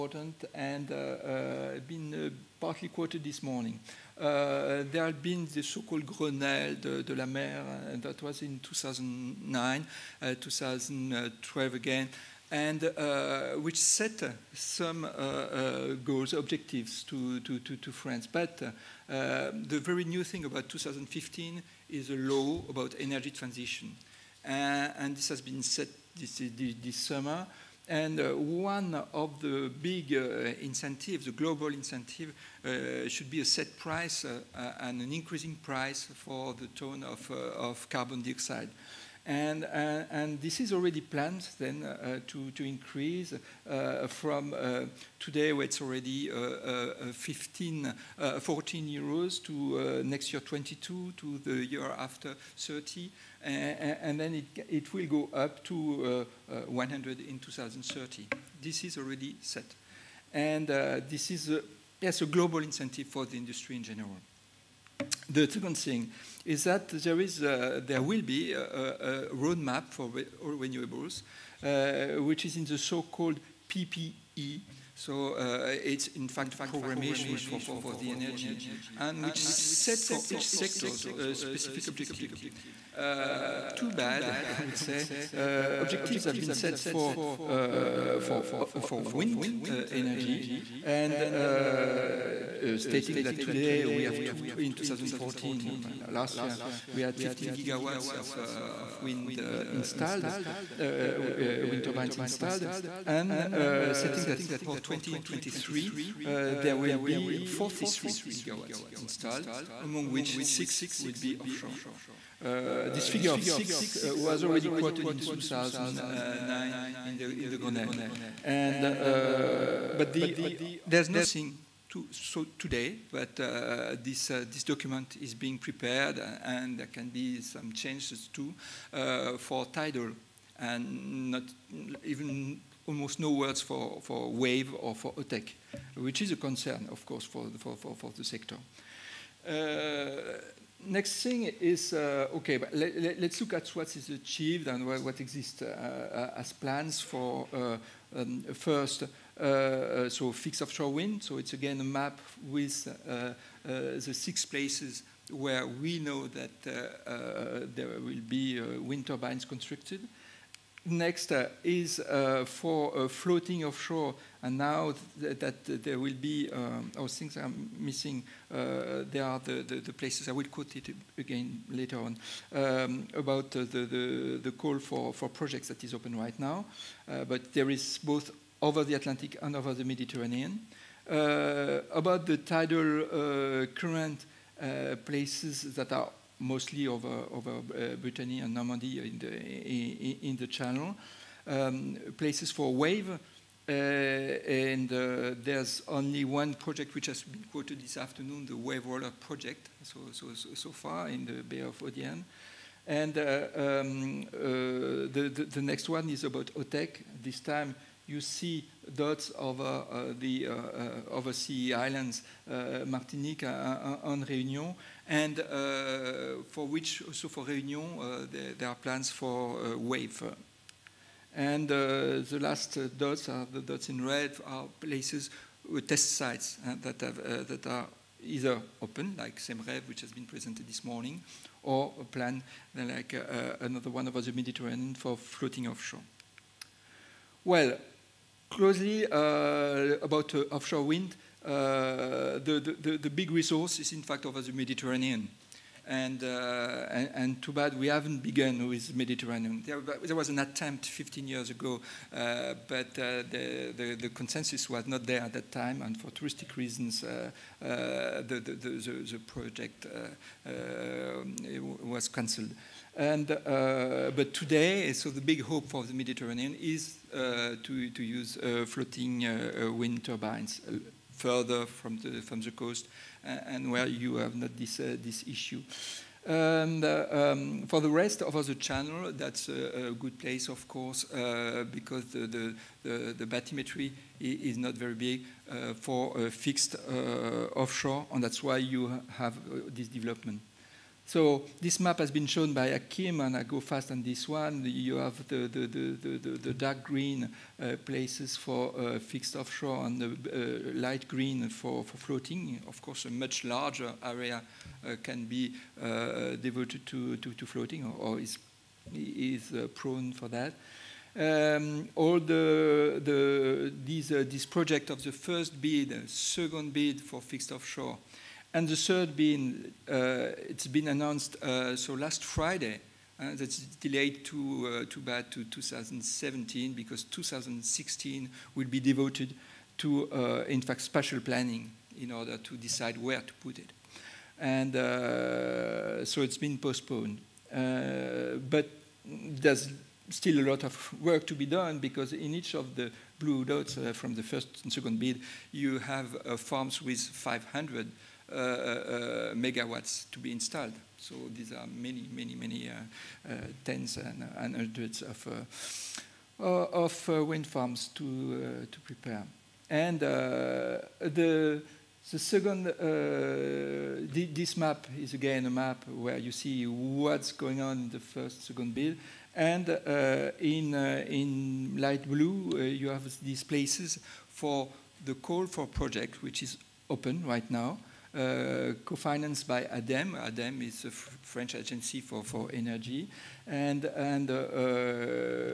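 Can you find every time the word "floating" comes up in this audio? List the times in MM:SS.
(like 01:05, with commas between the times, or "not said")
02:43, 03:55, 04:28, 05:01, 05:07.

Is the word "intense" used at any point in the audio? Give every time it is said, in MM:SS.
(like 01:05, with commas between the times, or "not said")
not said.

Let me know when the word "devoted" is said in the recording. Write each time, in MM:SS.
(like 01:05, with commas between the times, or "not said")
05:06, 05:28.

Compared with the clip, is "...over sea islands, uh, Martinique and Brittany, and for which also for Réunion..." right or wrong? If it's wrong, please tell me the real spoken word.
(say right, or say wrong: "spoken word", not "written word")
wrong: "Réunion", not "Brittany".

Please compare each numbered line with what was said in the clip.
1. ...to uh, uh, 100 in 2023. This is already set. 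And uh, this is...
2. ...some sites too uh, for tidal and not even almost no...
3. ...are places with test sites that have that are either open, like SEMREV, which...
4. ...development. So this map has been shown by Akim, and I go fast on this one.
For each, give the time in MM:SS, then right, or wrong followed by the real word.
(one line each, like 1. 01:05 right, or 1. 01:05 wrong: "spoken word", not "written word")
1. 00:55 wrong: "2030", not "2023"
2. 02:07 wrong: "changes", not "sites"
3. 03:44 right
4. 04:49 right.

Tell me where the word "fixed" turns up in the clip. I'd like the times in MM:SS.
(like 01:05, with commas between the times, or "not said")
02:30, 04:46, 04:58, 05:17.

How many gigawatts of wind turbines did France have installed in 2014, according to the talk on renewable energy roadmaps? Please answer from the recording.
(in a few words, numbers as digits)
15 gigawatts.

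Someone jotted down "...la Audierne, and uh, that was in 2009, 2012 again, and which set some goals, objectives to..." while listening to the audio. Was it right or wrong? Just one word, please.
wrong.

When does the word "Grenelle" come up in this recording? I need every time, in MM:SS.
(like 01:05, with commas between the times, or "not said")
00:06, 01:57.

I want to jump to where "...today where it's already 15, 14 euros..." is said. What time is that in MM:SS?
00:45.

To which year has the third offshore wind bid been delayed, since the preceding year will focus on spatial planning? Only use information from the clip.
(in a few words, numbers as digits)
2017.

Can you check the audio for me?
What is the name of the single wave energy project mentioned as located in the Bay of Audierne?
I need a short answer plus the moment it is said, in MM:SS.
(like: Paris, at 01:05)
Wave Roller Project, at 03:18.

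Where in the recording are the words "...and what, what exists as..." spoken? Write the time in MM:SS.
02:24.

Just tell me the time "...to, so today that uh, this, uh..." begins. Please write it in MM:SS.
02:01.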